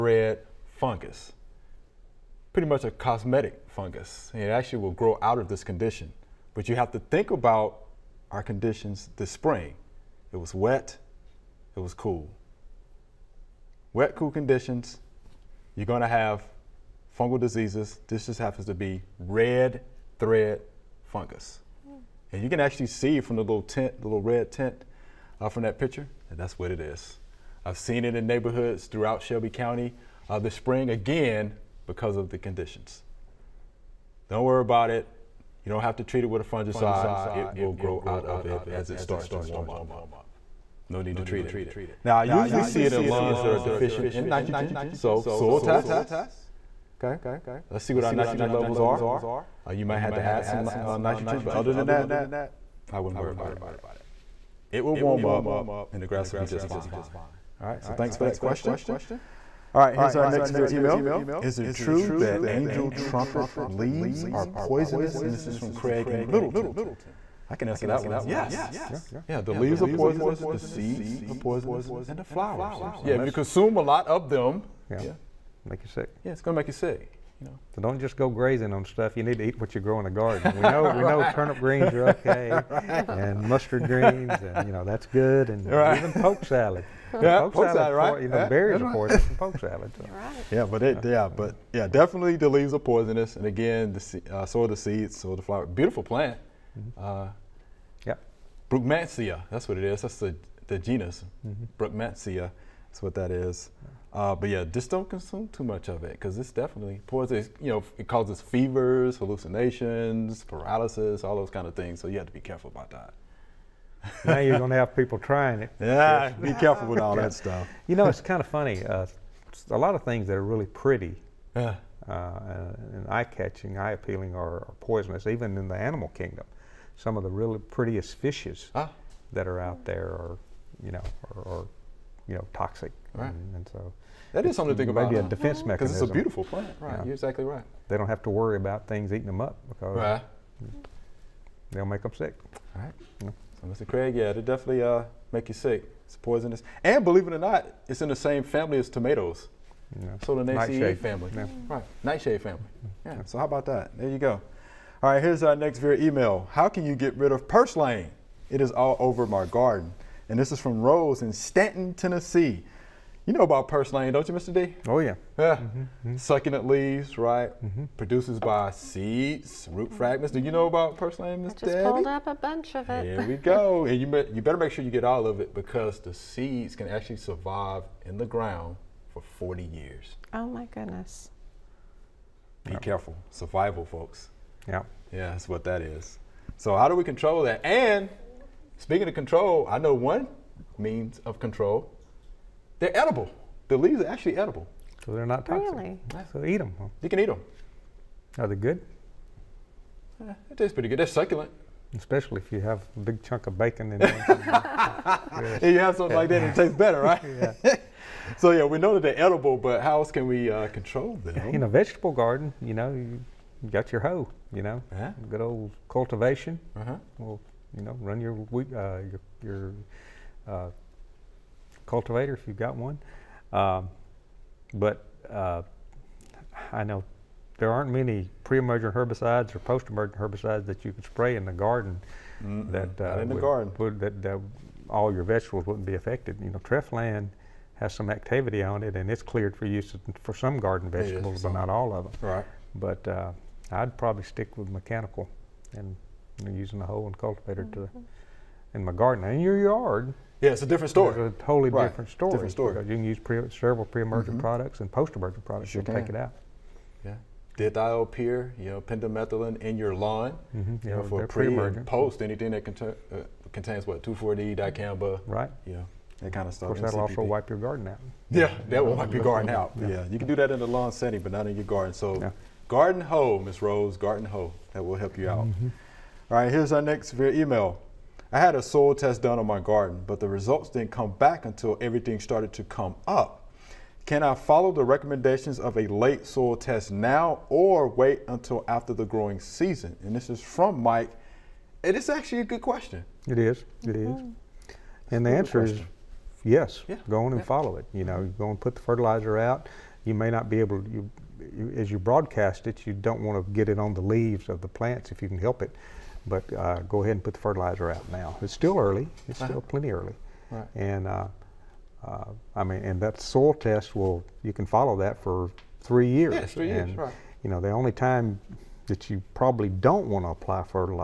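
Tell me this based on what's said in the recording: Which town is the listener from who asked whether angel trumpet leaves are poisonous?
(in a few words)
Middleton.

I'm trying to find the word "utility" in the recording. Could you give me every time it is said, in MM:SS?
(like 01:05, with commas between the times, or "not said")
not said.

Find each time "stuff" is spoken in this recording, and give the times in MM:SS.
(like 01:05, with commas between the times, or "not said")
01:18, 01:57, 04:26.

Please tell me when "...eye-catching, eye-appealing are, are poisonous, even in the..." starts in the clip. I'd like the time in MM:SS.
02:03.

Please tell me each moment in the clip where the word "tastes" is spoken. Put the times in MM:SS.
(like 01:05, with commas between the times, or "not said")
03:20, 03:26.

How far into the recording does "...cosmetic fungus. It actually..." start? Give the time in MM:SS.
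00:02.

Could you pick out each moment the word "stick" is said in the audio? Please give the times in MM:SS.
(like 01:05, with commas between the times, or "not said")
04:04.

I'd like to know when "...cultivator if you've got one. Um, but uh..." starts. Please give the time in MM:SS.
03:41.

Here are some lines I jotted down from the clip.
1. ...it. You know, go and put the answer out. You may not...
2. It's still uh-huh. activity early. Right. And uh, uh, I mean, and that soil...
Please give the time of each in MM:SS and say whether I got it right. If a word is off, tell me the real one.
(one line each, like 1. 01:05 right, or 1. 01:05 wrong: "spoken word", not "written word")
1. 04:57 wrong: "fertilizer", not "answer"
2. 05:09 wrong: "plenty", not "activity".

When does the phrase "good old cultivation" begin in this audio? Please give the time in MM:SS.
03:35.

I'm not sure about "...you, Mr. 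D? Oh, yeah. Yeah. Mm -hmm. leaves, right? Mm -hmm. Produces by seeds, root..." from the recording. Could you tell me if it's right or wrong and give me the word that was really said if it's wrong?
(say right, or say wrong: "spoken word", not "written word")
right.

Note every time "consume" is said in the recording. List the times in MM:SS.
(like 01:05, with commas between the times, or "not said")
01:13, 01:45.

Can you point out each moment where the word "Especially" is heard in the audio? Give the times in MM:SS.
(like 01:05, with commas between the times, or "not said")
03:21.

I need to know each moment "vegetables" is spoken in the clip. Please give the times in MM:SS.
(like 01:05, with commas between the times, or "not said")
03:31, 03:55, 04:00.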